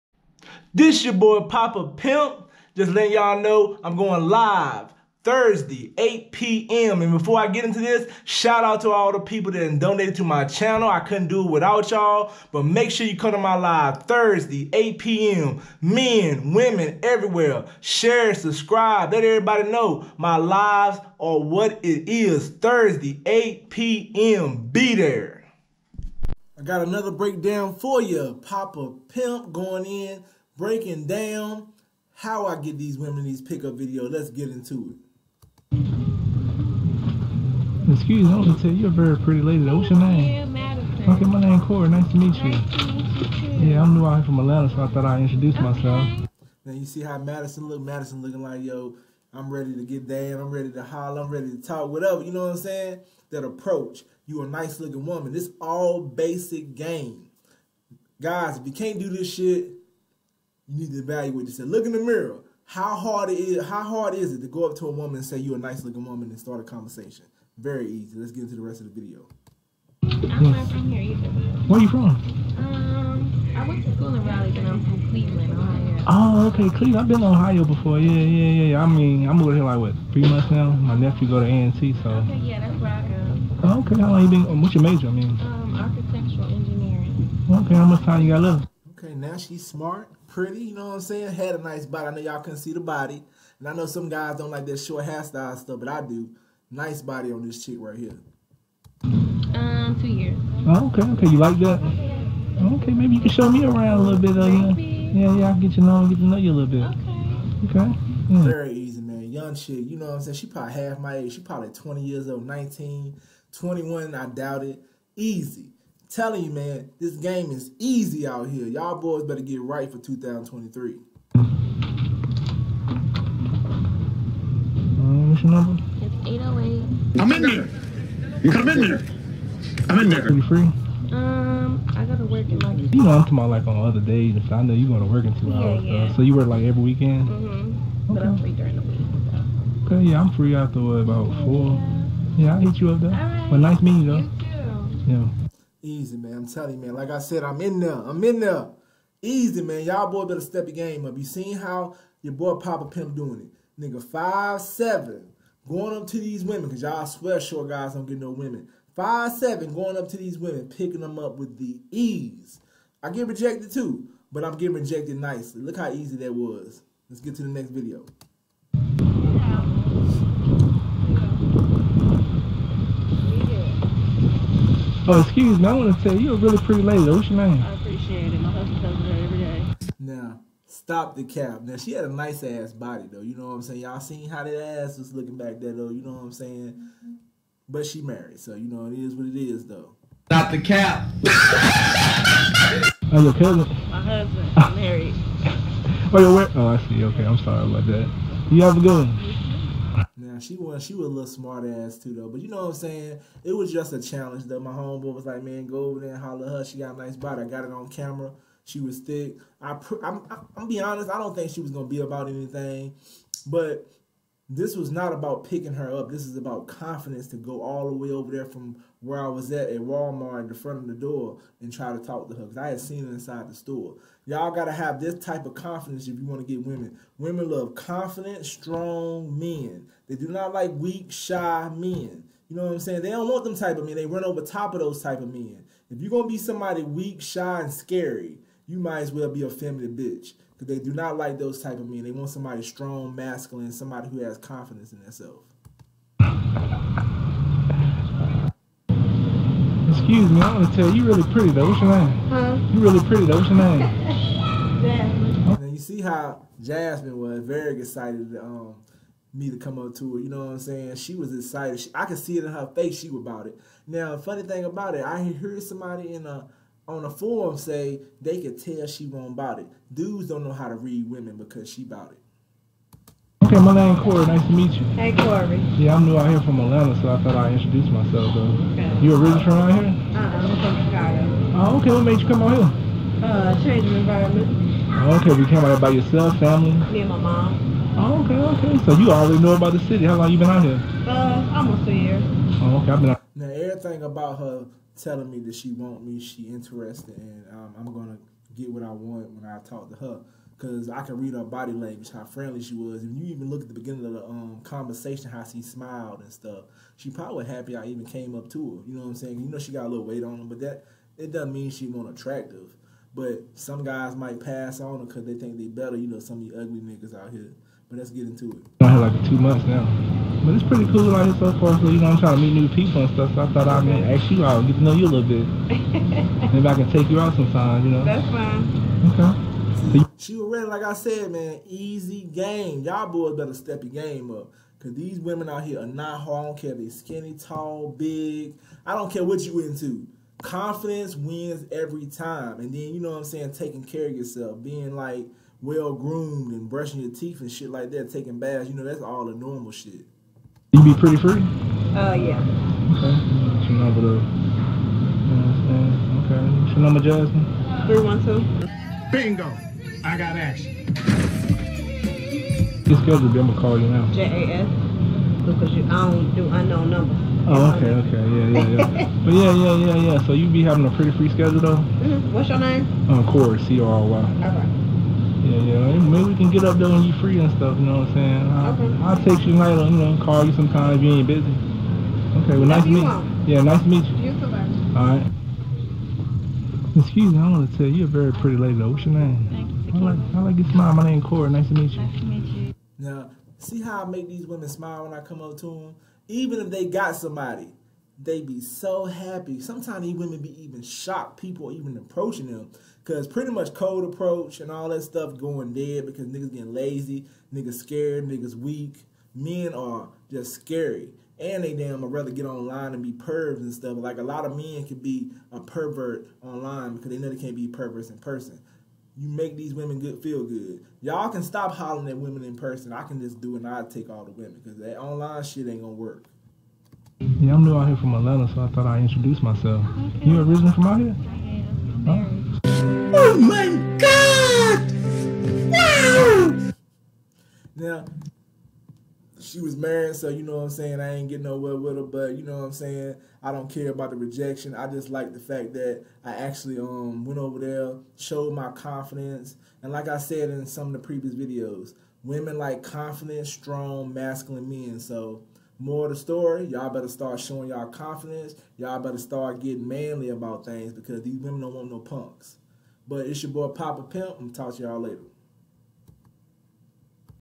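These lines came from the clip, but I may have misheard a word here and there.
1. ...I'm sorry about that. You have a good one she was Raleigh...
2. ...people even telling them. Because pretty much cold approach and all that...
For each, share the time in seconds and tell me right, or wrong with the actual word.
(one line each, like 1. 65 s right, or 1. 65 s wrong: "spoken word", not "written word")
1. 197 s wrong: "She", not "Raleigh"
2. 401 s wrong: "approaching", not "telling".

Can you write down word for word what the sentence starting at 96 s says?
Nice body on this chick right here.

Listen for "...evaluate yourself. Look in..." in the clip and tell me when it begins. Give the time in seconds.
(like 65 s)
60 s.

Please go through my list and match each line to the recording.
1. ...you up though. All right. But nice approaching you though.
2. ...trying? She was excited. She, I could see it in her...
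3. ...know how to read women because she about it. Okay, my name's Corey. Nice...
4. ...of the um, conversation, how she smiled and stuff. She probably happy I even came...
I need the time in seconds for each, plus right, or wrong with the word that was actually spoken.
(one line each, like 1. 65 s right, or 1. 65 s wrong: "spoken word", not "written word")
1. 142 s wrong: "meeting", not "approaching"
2. 260 s wrong: "saying", not "trying"
3. 270 s right
4. 304 s right.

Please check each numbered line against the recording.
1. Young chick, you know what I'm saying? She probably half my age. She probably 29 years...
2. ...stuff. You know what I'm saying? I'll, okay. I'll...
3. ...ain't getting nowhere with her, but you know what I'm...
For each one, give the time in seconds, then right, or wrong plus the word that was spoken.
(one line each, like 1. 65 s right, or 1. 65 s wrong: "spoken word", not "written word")
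1. 109 s wrong: "20", not "29"
2. 377 s right
3. 441 s right.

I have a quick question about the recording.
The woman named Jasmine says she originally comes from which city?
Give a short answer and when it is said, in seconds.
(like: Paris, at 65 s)
Chicago, at 280 s.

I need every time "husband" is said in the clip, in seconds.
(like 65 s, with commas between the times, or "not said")
178 s, 194 s.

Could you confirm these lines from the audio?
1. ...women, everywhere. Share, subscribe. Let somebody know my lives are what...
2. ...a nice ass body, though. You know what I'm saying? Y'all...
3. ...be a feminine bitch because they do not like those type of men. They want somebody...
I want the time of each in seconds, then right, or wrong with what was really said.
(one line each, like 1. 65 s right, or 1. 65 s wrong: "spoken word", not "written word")
1. 16 s wrong: "everybody", not "somebody"
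2. 182 s right
3. 239 s right.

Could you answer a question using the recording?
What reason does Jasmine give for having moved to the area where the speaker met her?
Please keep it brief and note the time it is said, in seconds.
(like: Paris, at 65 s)
Change of environment, at 283 s.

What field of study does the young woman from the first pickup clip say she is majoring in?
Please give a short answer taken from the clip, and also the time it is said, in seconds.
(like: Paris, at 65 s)
Architectural engineering, at 85 s.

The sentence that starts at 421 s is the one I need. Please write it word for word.
Y'all can stop hollering at women in person.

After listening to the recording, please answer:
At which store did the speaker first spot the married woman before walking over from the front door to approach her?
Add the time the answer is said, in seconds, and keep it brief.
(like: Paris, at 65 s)
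Walmart, at 219 s.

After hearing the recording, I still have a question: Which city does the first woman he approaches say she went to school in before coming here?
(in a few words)
Raleigh.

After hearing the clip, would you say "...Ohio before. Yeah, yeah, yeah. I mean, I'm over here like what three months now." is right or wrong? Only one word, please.
right.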